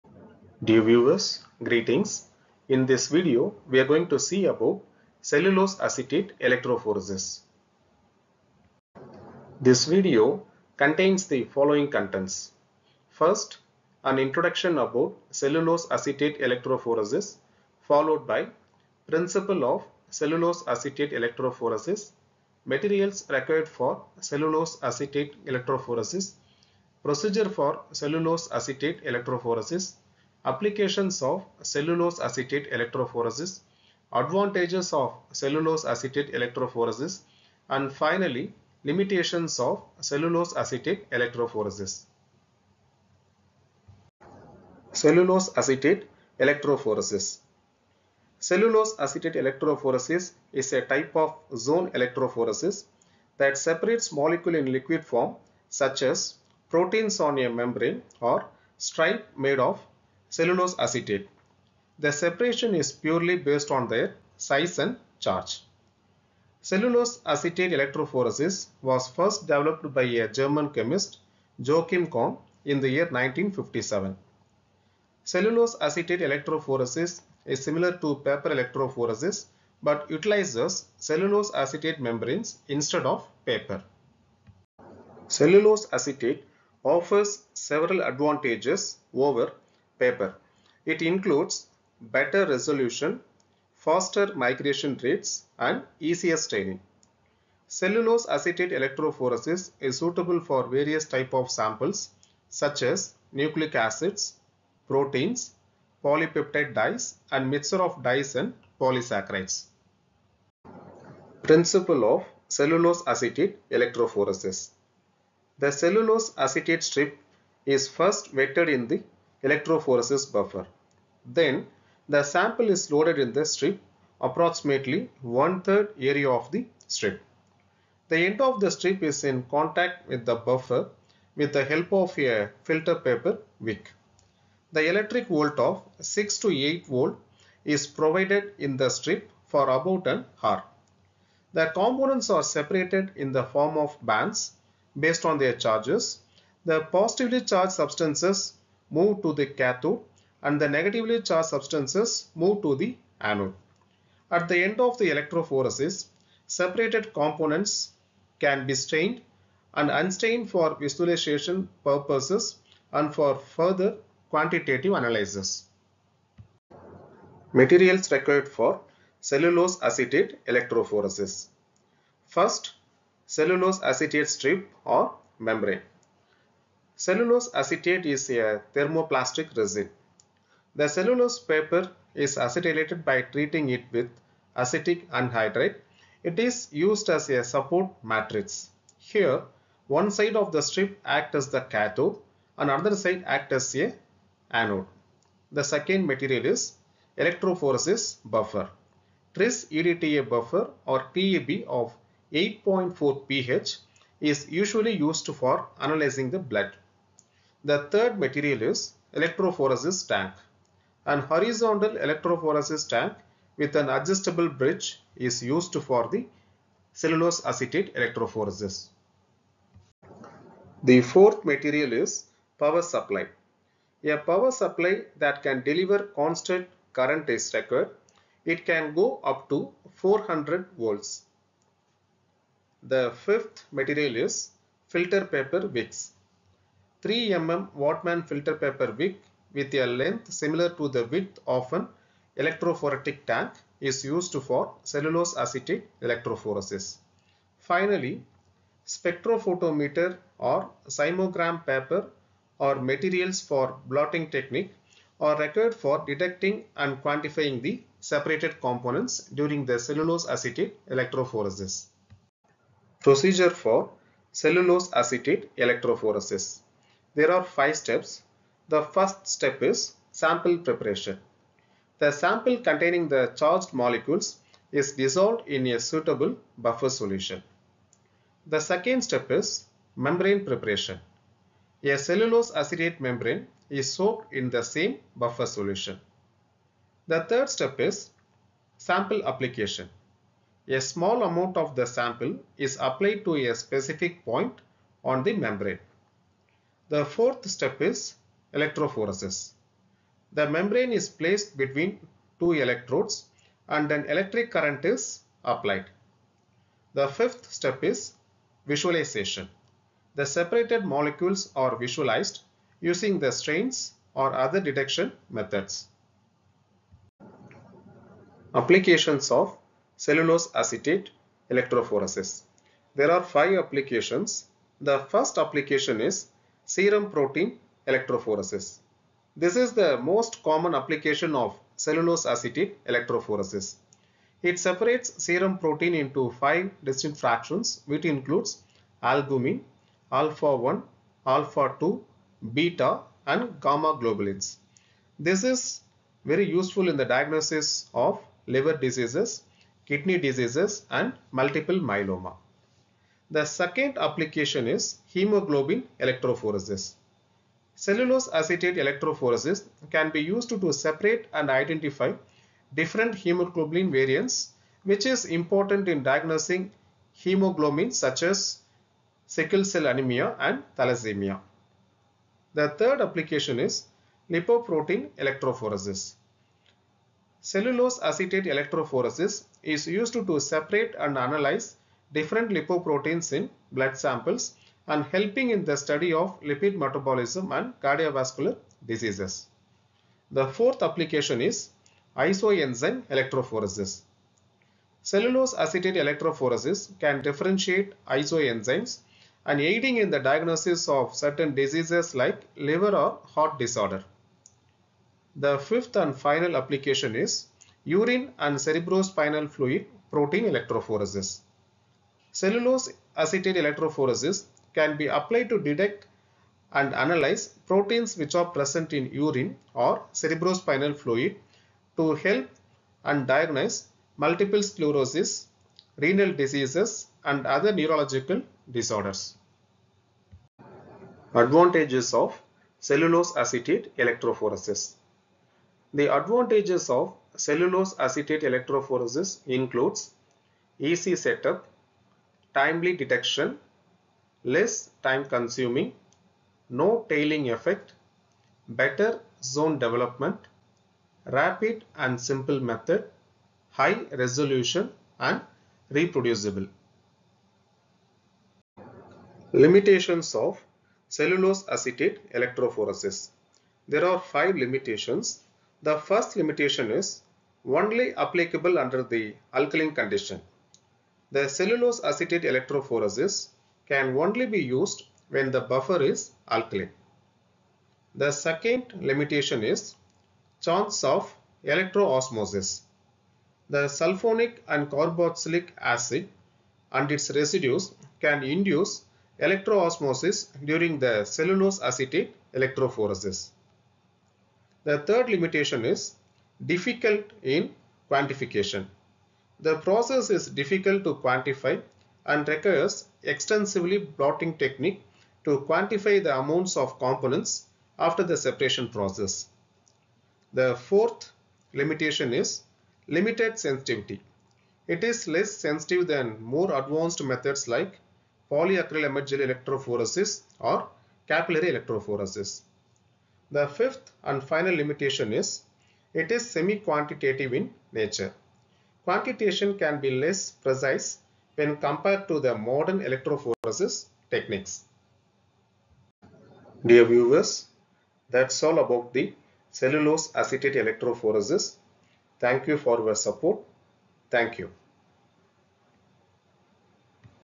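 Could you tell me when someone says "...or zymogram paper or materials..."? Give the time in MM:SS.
04:10.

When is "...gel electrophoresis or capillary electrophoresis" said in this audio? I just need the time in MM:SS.
08:39.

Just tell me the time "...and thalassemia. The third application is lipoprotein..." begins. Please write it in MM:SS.
06:10.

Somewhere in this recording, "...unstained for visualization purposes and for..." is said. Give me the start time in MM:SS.
02:39.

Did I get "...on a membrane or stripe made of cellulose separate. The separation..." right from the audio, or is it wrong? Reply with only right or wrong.
wrong.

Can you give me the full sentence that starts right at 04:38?
The second step is membrane preparation.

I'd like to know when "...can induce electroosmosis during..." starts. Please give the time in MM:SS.
08:08.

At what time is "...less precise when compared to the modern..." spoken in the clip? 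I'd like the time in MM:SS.
08:50.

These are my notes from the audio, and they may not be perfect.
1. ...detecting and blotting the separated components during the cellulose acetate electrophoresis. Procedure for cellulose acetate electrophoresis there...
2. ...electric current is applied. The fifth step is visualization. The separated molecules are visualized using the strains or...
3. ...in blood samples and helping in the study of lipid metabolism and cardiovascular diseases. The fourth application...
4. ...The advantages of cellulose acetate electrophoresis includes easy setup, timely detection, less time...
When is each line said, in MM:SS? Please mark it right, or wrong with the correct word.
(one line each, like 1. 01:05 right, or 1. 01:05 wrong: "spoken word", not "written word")
1. 04:16 wrong: "quantifying", not "blotting"
2. 05:04 right
3. 06:23 right
4. 07:15 right.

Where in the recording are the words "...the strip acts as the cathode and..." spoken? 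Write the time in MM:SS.
03:10.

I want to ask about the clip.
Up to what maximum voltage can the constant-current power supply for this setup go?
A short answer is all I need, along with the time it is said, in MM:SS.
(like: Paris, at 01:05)
400 volts, at 03:49.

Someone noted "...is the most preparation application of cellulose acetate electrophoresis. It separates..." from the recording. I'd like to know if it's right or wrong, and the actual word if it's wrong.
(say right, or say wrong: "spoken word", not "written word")
wrong: "common", not "preparation".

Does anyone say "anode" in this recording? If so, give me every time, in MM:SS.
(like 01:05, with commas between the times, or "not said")
02:33, 03:14.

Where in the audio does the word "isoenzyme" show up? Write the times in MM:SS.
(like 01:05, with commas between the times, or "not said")
06:32, 06:38.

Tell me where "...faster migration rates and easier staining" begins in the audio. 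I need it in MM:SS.
01:33.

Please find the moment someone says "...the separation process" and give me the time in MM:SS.
08:28.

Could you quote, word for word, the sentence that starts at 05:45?
This is very useful in the diagnosis of liver diseases, kidney diseases and multiple myeloma.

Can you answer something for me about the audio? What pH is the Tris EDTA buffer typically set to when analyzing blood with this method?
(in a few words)
8.4.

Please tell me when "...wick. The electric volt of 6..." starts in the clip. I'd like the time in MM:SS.
02:13.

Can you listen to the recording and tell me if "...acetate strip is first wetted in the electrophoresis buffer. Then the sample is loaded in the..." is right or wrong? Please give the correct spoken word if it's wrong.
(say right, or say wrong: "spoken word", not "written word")
right.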